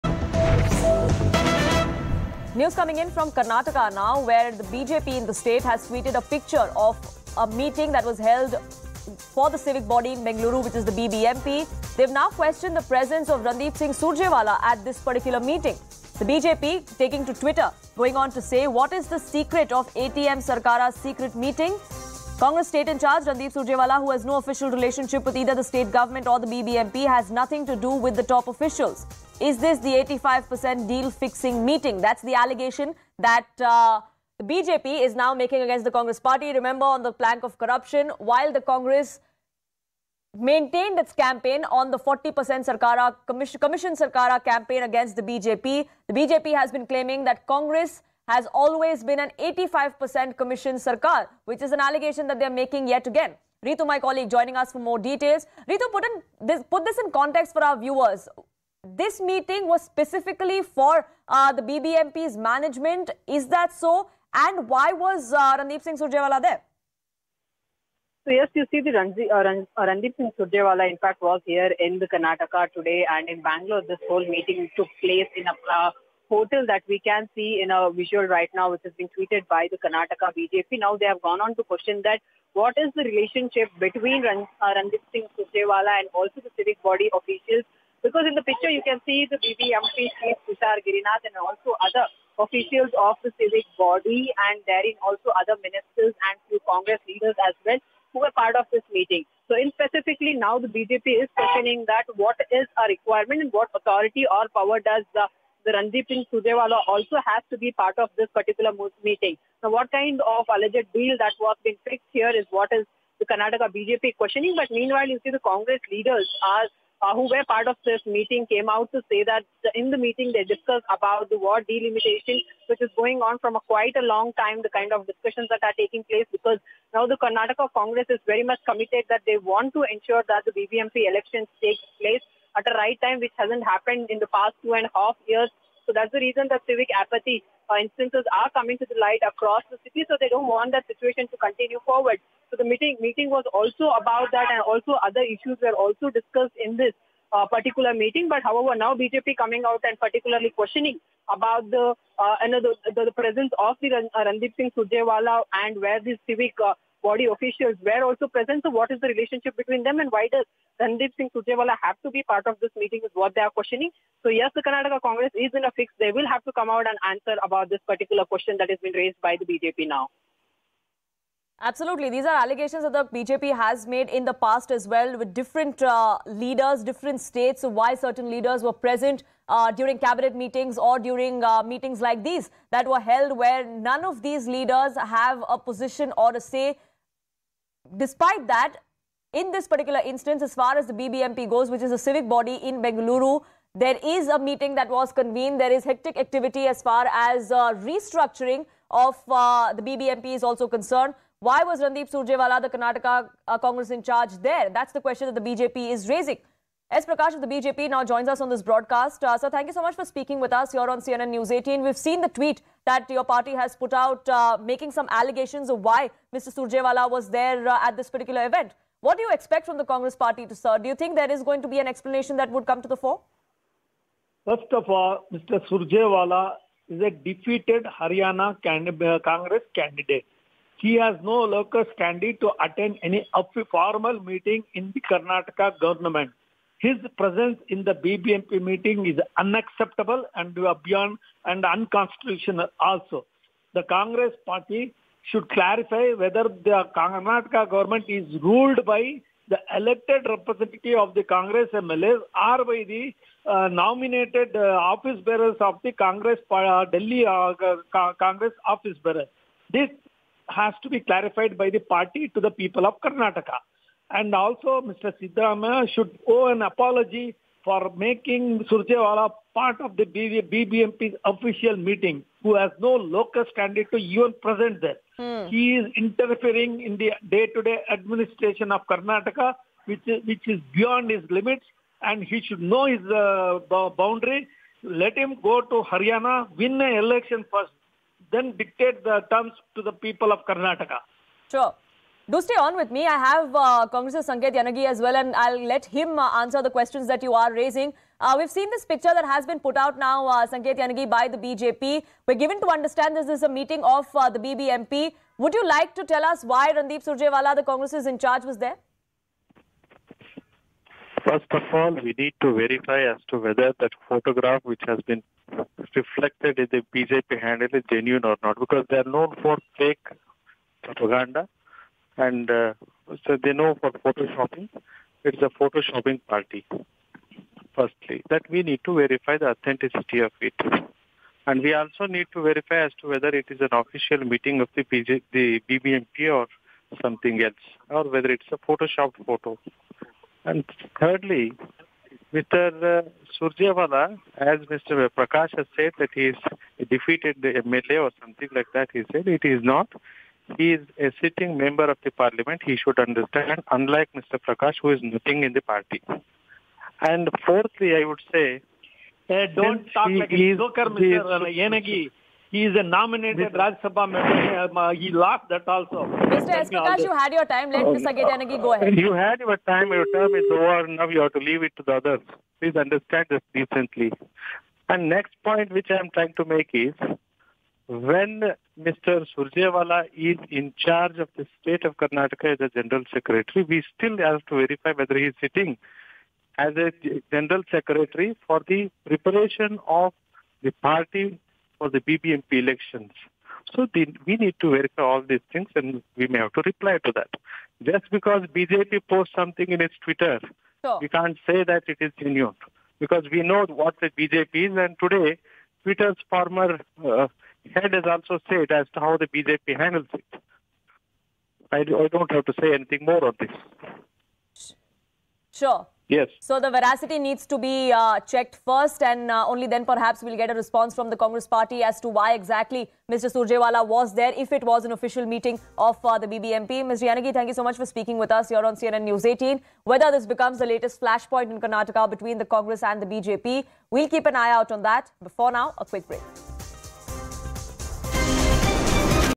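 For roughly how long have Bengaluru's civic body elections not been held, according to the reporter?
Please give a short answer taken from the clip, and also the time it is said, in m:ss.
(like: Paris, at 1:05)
2.5 years, at 2:14.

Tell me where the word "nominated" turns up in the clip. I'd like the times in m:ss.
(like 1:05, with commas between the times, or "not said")
4:13, 6:02.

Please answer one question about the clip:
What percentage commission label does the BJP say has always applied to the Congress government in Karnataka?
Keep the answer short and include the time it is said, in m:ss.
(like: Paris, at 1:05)
85%, at 0:49.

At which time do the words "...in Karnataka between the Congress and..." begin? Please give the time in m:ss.
7:11.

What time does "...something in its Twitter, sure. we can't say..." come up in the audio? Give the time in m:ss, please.
6:39.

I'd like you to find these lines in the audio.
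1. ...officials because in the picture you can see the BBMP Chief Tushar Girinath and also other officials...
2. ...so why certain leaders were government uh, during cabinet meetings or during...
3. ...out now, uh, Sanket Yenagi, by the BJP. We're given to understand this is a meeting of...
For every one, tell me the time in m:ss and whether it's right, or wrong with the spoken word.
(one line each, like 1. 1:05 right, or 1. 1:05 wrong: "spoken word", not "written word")
1. 1:27 right
2. 2:57 wrong: "present", not "government"
3. 4:59 right.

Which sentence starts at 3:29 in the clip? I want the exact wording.
Uh, sir, thank you so much for speaking with us here on CNN News 18.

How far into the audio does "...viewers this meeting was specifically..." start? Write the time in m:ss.
0:57.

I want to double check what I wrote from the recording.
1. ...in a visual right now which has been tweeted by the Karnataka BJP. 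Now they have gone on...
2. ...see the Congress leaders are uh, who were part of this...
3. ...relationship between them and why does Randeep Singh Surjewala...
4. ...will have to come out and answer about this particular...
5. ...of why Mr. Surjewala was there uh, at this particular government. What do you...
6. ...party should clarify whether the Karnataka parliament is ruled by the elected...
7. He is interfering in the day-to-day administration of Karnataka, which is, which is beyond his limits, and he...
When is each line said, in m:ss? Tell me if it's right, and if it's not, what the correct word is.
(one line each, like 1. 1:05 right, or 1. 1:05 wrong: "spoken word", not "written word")
1. 1:17 right
2. 1:55 right
3. 2:39 right
4. 2:46 right
5. 3:35 wrong: "event", not "government"
6. 4:04 wrong: "government", not "parliament"
7. 4:35 right.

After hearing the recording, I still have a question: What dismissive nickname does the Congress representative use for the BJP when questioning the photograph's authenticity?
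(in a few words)
photoshopping party.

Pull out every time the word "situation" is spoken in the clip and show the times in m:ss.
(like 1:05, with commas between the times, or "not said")
2:20.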